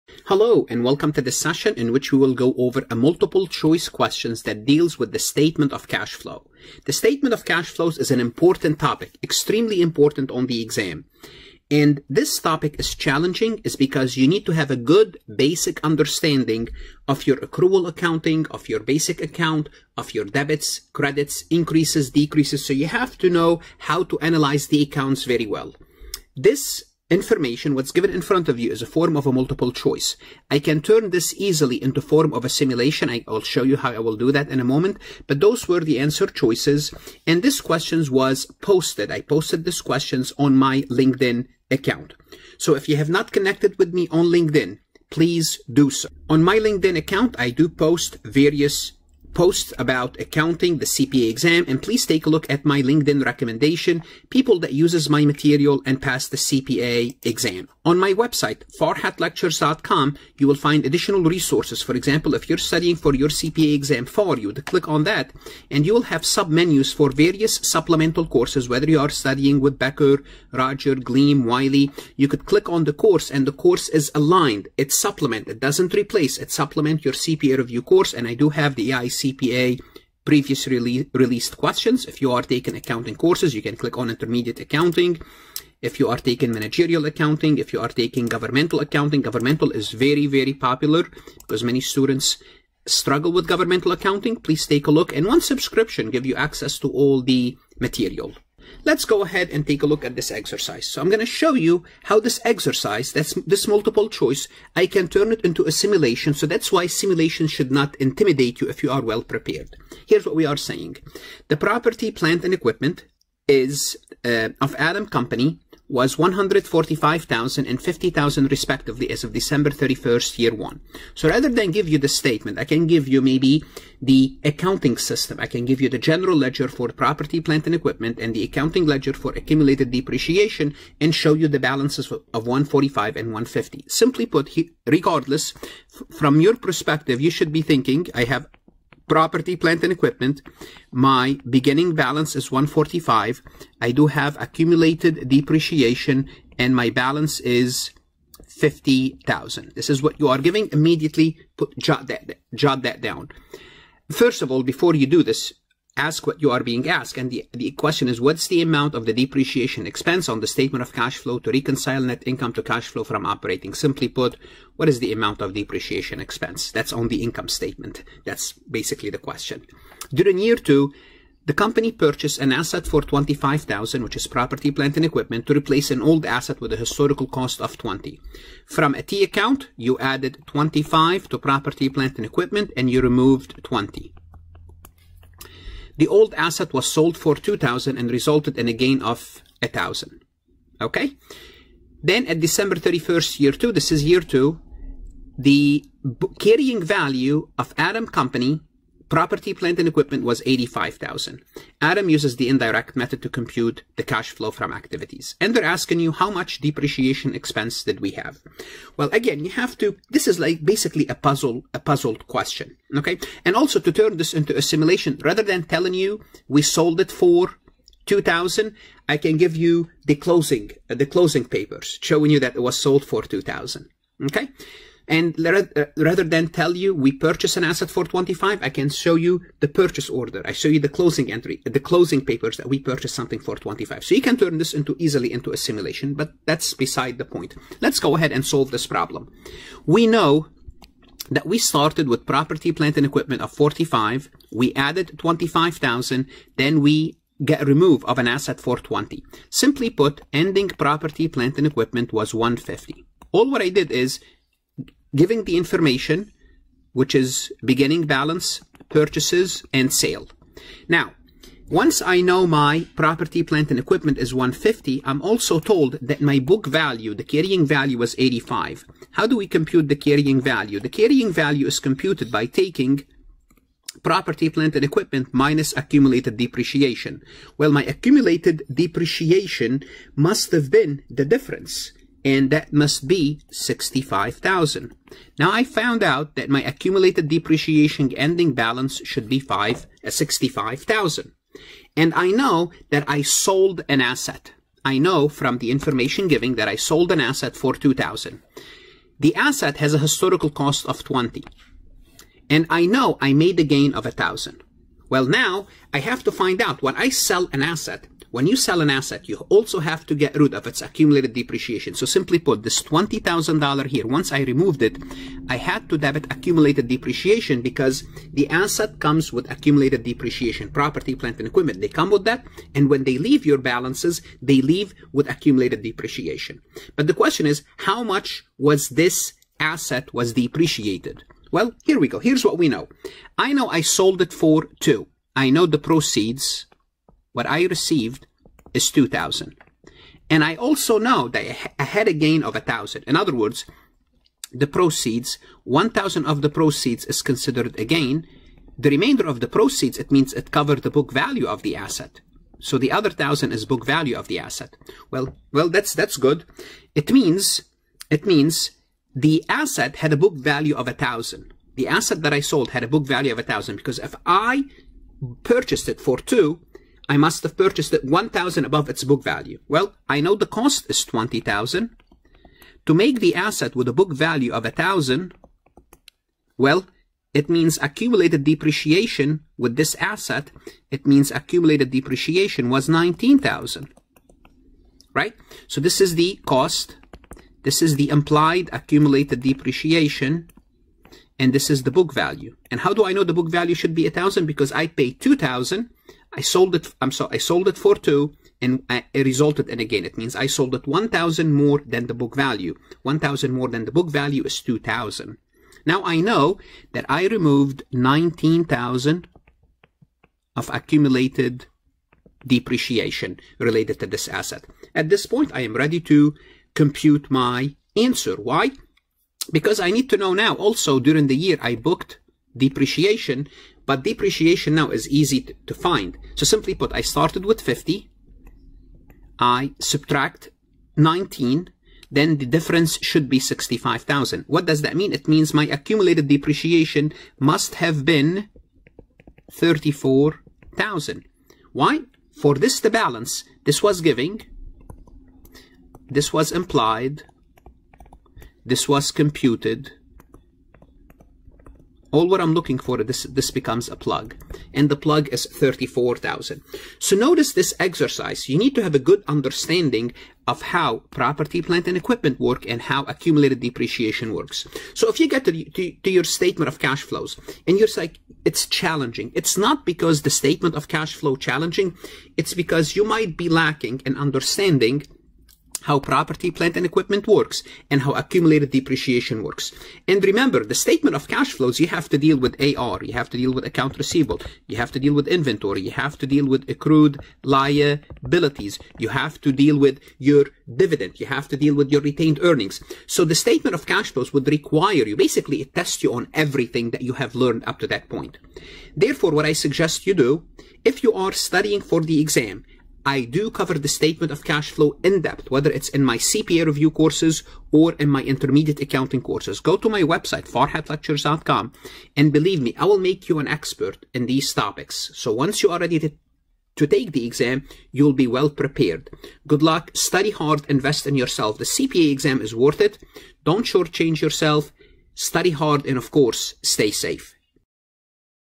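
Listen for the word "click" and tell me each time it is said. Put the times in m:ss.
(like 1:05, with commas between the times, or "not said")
1:04, 1:12, 1:23.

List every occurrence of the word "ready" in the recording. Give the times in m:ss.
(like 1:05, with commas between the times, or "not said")
6:55, 8:35.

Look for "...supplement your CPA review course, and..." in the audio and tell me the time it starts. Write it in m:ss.
1:16.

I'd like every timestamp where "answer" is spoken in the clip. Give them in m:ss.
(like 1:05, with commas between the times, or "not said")
0:35, 6:57.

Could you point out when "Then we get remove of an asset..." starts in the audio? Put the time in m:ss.
4:06.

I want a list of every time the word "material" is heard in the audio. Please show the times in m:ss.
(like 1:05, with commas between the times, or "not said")
0:55, 1:37.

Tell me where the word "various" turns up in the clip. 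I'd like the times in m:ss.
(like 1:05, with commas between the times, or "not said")
0:48, 1:07.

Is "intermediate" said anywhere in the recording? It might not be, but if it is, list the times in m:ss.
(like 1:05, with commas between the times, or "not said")
1:24, 8:28.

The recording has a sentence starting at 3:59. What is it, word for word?
We know that we started with property, plant, and equipment of 45.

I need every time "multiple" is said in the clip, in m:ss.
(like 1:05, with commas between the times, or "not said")
0:02, 0:29, 1:43.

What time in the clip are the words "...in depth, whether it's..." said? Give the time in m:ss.
8:25.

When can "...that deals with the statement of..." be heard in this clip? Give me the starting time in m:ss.
0:04.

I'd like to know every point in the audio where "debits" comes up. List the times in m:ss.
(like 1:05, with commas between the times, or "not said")
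0:20, 5:15.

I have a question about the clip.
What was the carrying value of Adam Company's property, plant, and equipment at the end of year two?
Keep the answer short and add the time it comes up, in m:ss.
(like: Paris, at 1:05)
$85,000, at 3:20.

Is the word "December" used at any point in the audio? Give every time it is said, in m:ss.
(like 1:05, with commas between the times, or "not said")
1:59, 3:12.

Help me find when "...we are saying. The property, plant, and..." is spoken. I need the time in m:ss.
1:50.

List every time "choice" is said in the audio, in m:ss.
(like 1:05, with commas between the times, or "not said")
0:03, 0:29, 0:36, 1:44.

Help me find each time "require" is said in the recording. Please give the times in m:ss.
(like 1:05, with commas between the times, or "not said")
8:14.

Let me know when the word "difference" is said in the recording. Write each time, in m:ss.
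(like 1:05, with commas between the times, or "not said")
4:41, 7:12.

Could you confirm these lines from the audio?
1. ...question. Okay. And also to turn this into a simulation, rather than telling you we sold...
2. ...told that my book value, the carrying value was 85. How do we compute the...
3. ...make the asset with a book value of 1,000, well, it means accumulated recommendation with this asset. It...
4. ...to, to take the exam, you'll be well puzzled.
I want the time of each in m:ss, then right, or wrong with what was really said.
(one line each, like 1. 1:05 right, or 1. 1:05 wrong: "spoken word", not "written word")
1. 3:32 right
2. 4:25 right
3. 6:12 wrong: "depreciation", not "recommendation"
4. 8:35 wrong: "prepared", not "puzzled".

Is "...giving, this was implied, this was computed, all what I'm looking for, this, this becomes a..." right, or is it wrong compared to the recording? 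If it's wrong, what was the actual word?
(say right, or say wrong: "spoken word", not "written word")
right.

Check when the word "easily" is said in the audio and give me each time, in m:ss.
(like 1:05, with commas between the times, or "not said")
0:31, 3:54.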